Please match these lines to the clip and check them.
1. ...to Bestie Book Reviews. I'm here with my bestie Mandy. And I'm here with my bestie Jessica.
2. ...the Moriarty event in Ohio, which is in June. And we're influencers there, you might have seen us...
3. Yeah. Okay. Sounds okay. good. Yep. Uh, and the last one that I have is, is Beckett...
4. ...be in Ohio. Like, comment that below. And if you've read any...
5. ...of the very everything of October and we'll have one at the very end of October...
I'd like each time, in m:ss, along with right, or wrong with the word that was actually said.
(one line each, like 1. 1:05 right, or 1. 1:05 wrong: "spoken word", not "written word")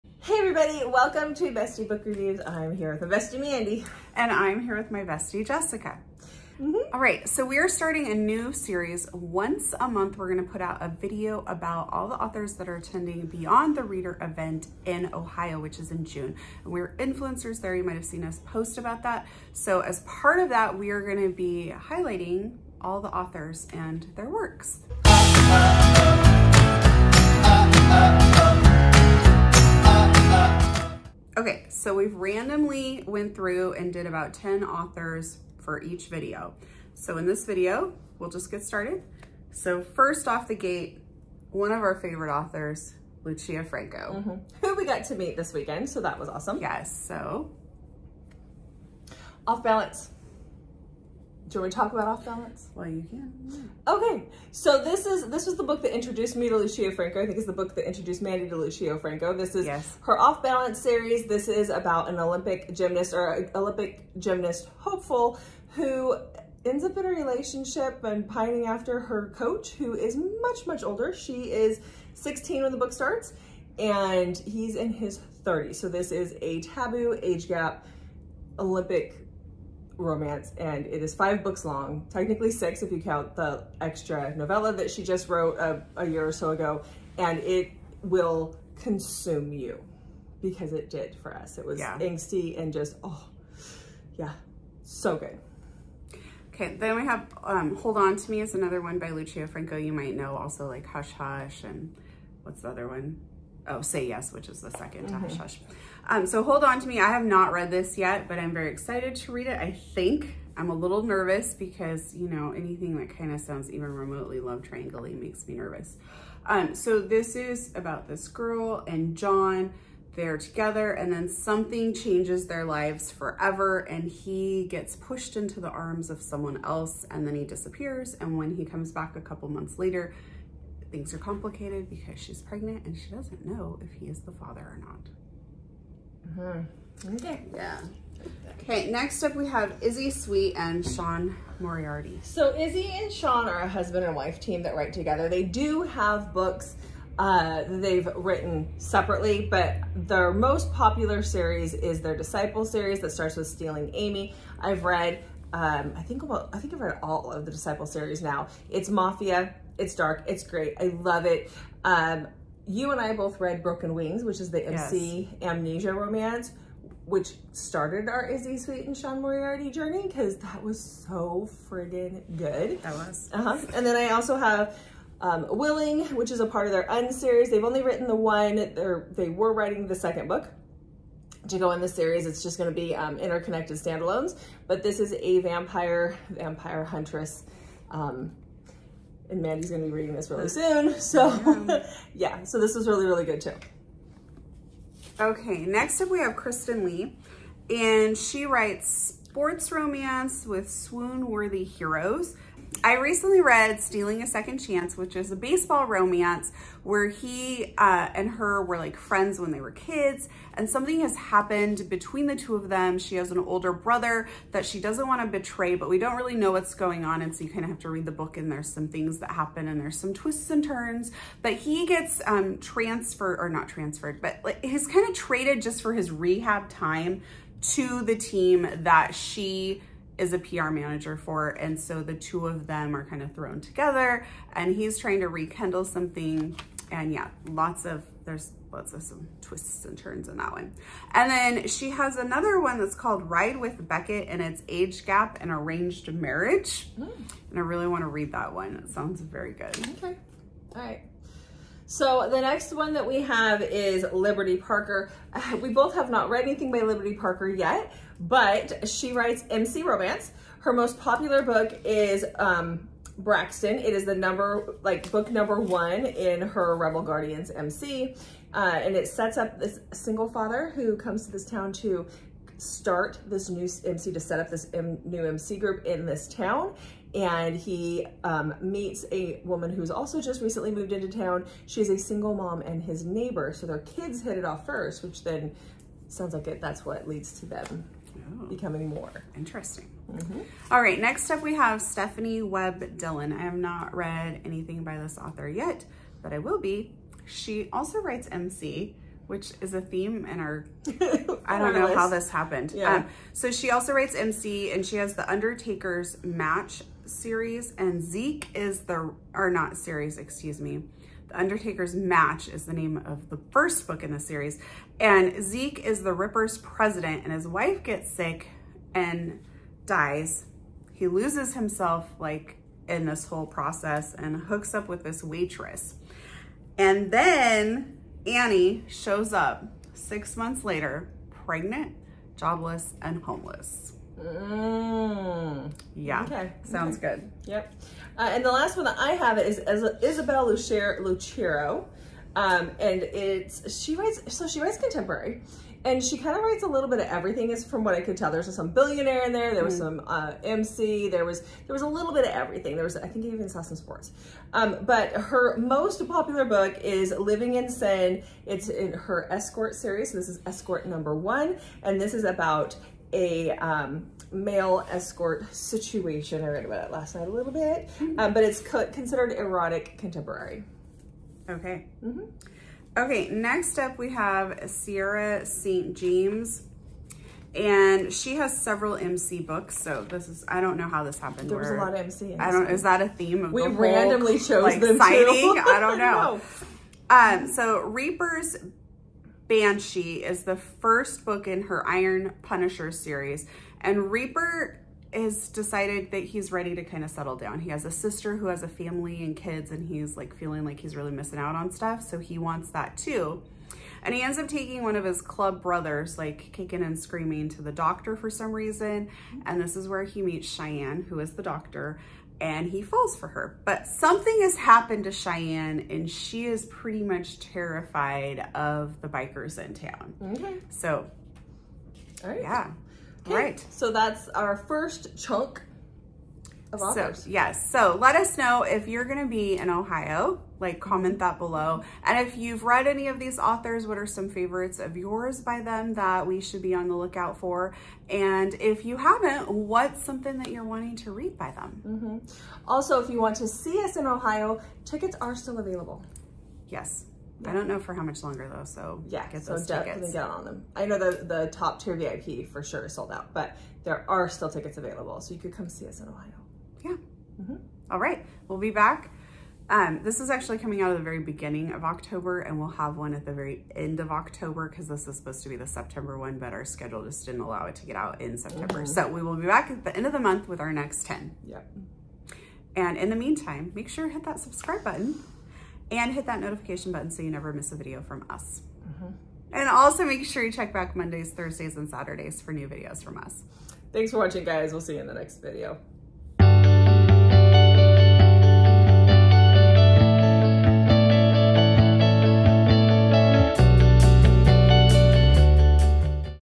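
1. 0:01 right
2. 0:13 wrong: "Reader", not "Moriarty"
3. 5:35 wrong: "Isabel", not "Beckett"
4. 7:09 right
5. 7:40 wrong: "beginning", not "everything".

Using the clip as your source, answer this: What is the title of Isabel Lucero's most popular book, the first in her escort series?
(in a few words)
Living in Sin.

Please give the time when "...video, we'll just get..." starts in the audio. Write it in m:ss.
0:37.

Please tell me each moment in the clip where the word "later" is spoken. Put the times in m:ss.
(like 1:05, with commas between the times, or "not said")
2:09, 5:30.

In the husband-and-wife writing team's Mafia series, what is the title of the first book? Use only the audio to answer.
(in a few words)
Stealing Amy.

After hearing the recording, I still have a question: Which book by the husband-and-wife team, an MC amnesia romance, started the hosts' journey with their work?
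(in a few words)
Broken Wings.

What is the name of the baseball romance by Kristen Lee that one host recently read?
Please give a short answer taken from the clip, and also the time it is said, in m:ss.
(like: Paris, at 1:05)
Stealing a Second Chance, at 3:23.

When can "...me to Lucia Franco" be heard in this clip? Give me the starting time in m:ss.
0:56.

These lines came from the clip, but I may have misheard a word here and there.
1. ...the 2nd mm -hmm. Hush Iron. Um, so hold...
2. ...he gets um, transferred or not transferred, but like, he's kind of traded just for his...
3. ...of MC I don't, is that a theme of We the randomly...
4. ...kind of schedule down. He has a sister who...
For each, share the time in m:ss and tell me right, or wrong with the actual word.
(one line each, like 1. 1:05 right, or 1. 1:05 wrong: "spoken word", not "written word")
1. 1:44 wrong: "Hush", not "Iron"
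2. 3:41 right
3. 6:21 right
4. 6:36 wrong: "settle", not "schedule".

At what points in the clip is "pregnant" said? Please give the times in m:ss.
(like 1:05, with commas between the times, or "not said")
2:12, 5:31.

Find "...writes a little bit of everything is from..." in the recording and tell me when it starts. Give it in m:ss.
5:46.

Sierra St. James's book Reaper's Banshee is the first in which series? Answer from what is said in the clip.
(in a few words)
Iron Punisher.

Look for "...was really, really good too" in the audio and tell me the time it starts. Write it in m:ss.
3:12.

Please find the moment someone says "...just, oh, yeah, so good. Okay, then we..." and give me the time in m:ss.
1:32.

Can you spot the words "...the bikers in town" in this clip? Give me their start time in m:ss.
6:59.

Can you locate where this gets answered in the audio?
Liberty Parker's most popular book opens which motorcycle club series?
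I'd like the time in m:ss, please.
4:26.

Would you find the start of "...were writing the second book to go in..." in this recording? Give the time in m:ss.
2:59.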